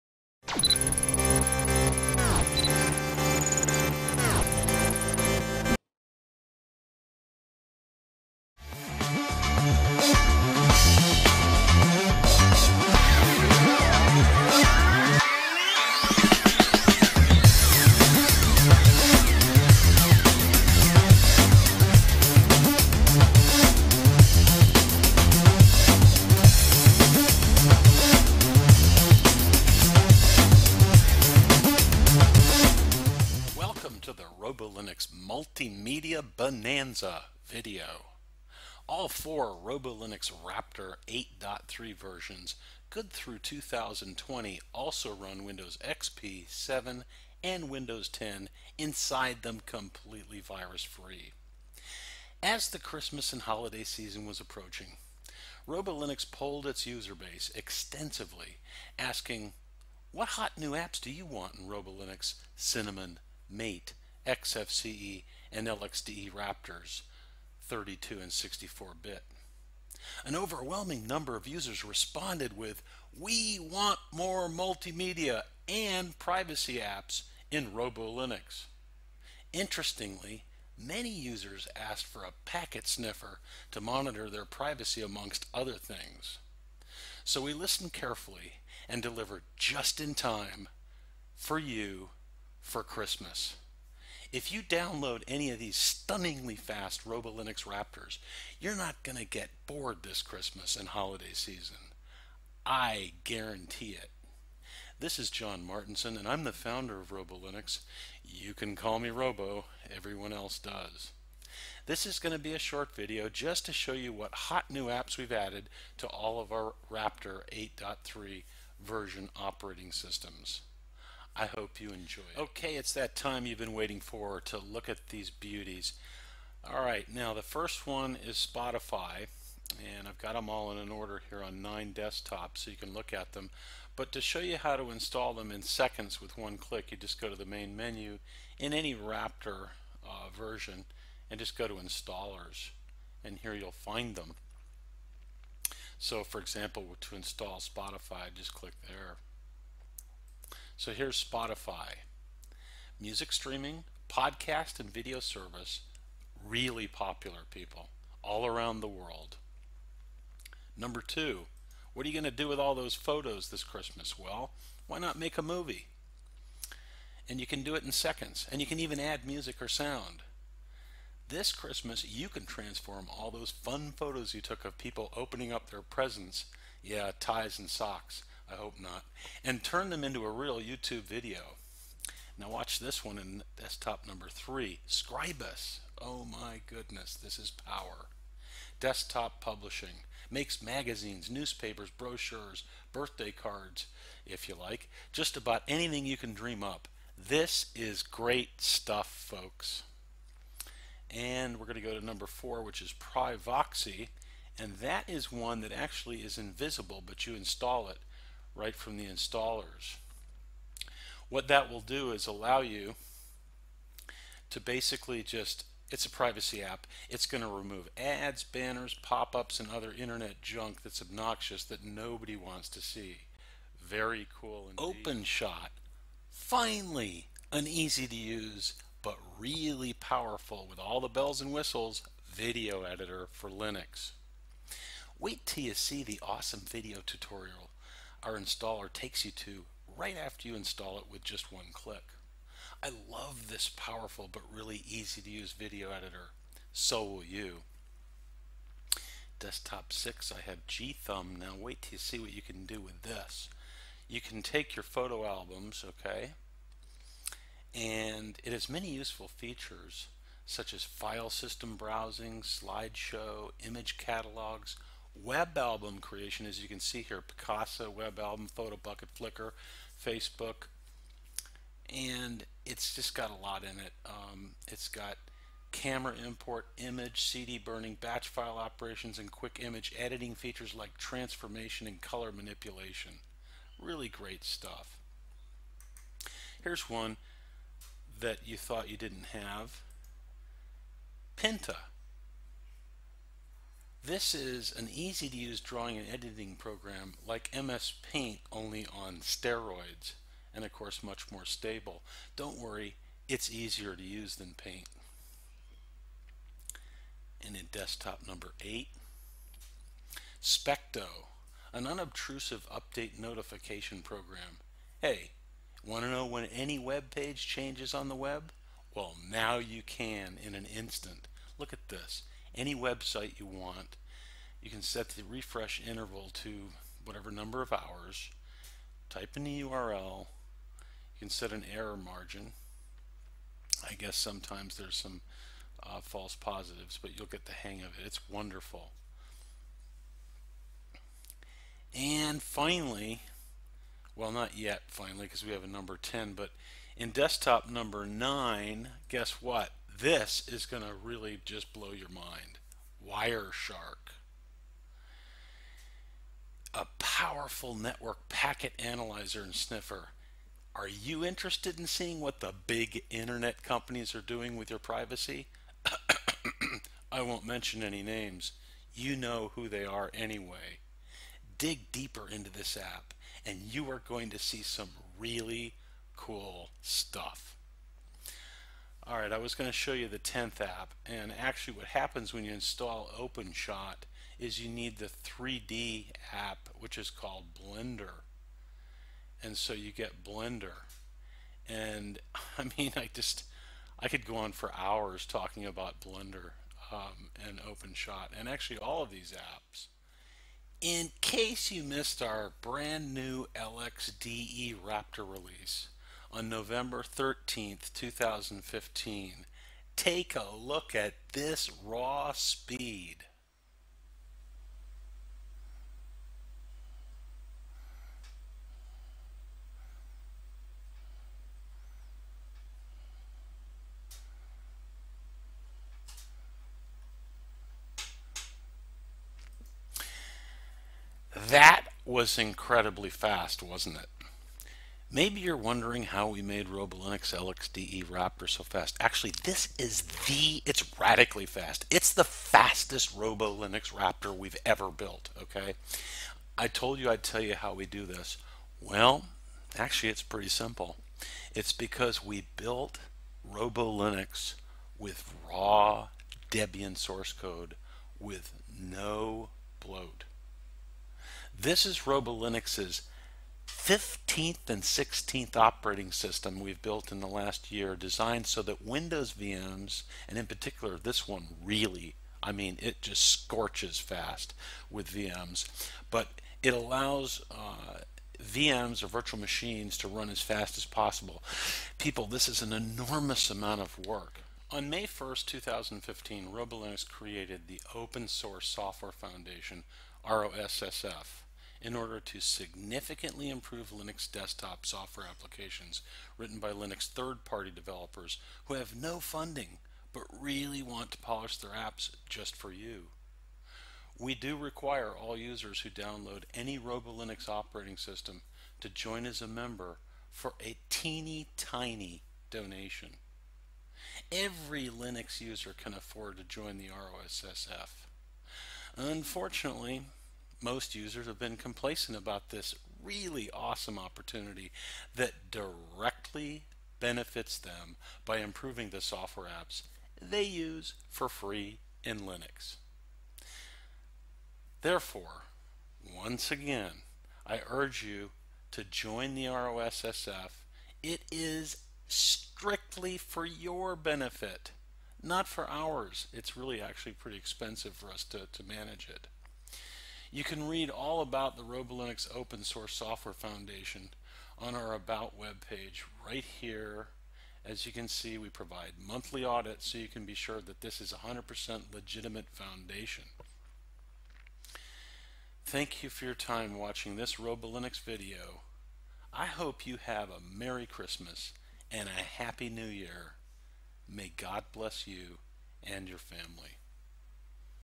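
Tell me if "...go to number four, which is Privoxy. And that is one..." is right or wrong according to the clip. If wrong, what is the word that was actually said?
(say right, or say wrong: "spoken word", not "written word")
right.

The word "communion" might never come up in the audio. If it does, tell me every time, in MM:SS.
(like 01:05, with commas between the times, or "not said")
not said.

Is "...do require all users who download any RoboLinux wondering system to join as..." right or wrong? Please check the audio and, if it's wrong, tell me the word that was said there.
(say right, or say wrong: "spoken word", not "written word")
wrong: "operating", not "wondering".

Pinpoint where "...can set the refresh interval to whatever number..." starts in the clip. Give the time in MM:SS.
05:24.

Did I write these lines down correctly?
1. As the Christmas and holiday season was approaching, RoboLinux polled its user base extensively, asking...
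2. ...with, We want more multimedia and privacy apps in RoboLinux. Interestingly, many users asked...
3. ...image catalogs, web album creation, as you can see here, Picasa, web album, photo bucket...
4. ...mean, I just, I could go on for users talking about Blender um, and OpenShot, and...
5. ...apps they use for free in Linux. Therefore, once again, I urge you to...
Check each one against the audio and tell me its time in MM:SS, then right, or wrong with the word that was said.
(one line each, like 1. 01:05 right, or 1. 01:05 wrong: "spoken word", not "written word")
1. 00:52 right
2. 01:12 right
3. 04:23 right
4. 06:32 wrong: "hours", not "users"
5. 08:49 right.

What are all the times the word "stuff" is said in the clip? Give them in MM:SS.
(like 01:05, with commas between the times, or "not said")
03:18, 04:44, 06:16.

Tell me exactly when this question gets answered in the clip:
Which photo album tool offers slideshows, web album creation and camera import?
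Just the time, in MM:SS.
04:10.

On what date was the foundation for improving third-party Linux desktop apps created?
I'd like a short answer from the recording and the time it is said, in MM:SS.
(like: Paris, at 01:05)
May 1st, 2015, at 08:04.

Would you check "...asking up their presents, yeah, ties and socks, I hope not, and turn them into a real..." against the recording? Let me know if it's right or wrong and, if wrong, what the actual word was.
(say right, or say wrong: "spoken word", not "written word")
wrong: "opening", not "asking".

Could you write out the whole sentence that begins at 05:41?
And finally, well, not yet finally because we have a number 10, but in desktop number 9, guess what?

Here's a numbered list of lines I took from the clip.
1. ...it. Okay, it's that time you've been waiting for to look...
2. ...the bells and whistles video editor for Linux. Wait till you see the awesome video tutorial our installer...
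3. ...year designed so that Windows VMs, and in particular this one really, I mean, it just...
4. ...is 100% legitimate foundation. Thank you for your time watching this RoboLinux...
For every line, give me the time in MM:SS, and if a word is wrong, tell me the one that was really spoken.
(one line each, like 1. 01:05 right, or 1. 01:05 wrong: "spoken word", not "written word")
1. 02:02 right
2. 03:51 right
3. 07:47 right
4. 09:21 right.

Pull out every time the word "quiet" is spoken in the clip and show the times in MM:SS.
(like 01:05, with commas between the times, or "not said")
not said.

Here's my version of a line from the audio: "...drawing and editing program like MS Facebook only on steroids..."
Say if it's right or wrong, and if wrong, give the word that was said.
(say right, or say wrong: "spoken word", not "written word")
wrong: "Paint", not "Facebook".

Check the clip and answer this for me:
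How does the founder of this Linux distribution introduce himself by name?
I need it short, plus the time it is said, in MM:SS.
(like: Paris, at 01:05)
John Martinson, at 01:45.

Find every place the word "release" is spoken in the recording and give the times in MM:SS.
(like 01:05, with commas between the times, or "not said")
06:45.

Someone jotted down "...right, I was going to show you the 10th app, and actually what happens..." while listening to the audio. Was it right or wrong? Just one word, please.
right.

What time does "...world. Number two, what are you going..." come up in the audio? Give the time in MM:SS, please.
02:38.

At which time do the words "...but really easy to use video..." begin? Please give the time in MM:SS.
04:04.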